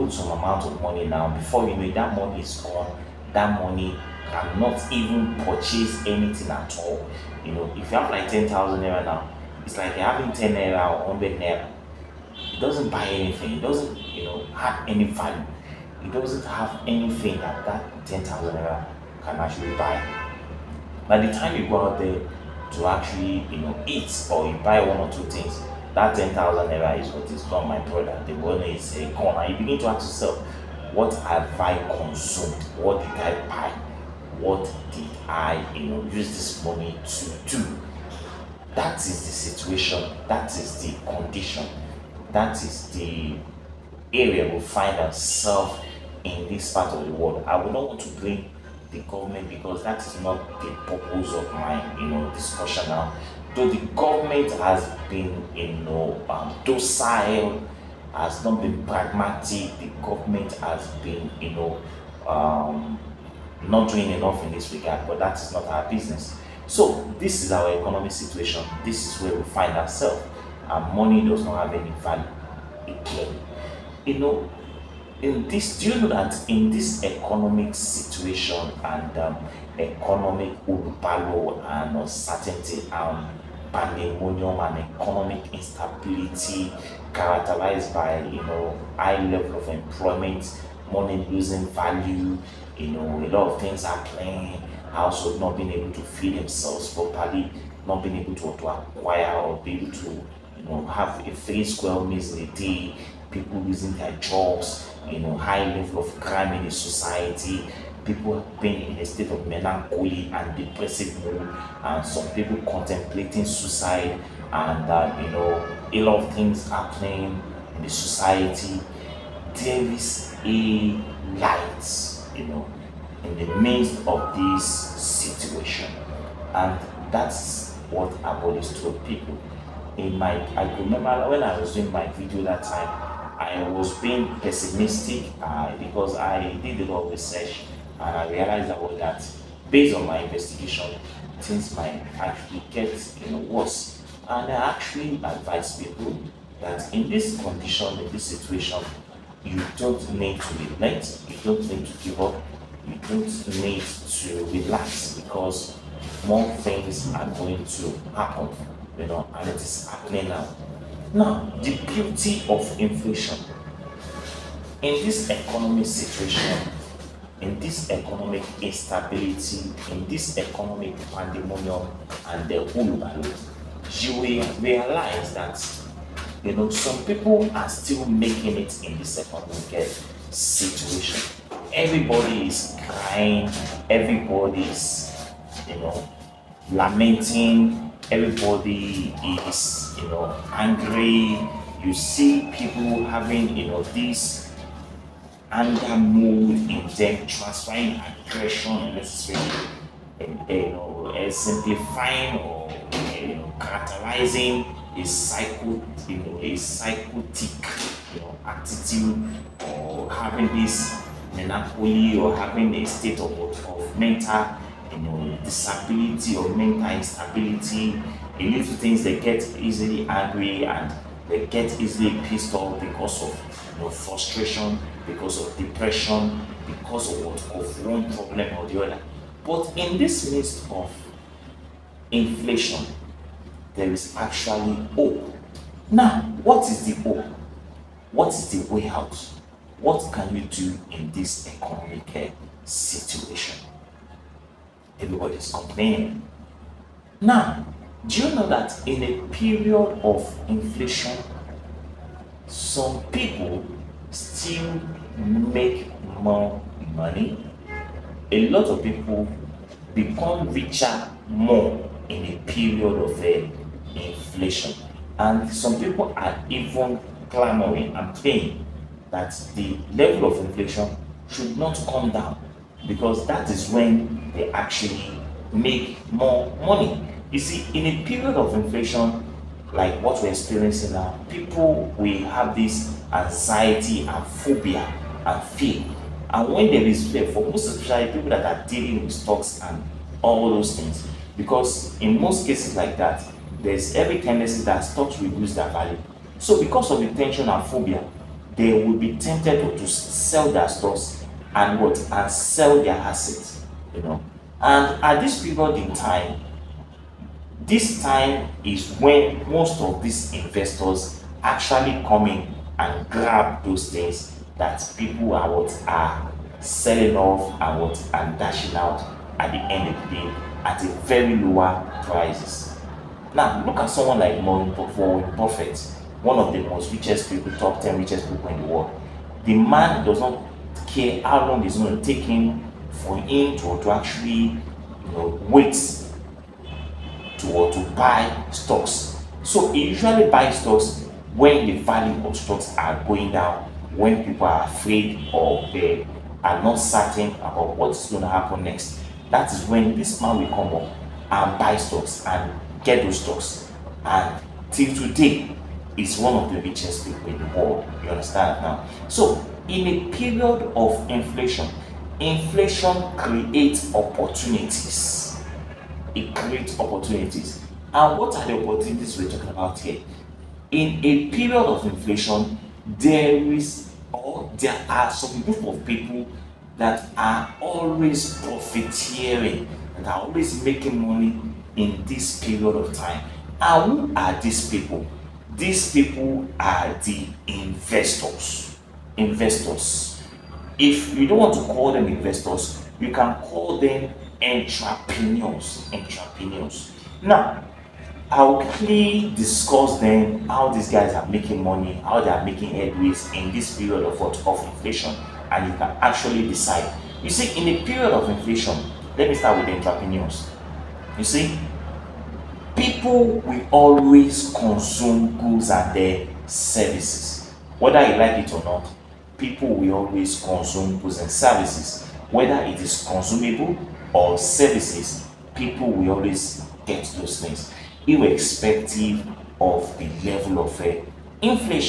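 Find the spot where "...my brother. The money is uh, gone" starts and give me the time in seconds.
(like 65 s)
27 s.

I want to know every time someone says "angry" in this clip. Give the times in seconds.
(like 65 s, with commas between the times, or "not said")
190 s, 220 s.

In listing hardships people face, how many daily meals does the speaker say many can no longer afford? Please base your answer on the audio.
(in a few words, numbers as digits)
3.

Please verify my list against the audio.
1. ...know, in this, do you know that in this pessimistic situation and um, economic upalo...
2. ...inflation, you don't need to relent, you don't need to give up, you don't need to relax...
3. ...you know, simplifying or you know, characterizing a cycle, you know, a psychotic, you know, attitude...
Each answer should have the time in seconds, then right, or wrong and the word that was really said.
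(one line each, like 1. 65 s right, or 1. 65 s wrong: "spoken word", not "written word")
1. 74 s wrong: "economic", not "pessimistic"
2. 148 s wrong: "situation", not "inflation"
3. 200 s right.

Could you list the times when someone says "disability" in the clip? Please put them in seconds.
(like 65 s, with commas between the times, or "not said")
215 s.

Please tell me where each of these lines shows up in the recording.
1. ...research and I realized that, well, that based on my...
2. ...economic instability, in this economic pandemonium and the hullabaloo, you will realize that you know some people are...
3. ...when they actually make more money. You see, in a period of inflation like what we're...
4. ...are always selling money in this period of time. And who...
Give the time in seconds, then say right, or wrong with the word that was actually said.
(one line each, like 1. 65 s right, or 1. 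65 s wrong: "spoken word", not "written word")
1. 137 s right
2. 167 s right
3. 273 s right
4. 380 s wrong: "making", not "selling".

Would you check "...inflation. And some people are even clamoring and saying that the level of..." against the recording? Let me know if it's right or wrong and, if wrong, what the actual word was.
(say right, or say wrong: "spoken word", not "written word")
right.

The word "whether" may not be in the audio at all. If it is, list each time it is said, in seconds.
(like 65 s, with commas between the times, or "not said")
417 s, 422 s.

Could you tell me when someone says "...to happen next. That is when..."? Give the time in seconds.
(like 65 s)
348 s.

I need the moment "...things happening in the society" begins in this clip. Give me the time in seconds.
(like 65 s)
116 s.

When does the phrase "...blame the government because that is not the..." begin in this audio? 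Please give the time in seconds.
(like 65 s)
48 s.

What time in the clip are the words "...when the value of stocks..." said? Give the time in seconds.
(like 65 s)
341 s.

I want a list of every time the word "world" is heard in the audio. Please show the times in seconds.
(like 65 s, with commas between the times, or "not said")
47 s, 328 s, 357 s.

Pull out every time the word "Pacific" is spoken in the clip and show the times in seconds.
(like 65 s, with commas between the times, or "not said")
not said.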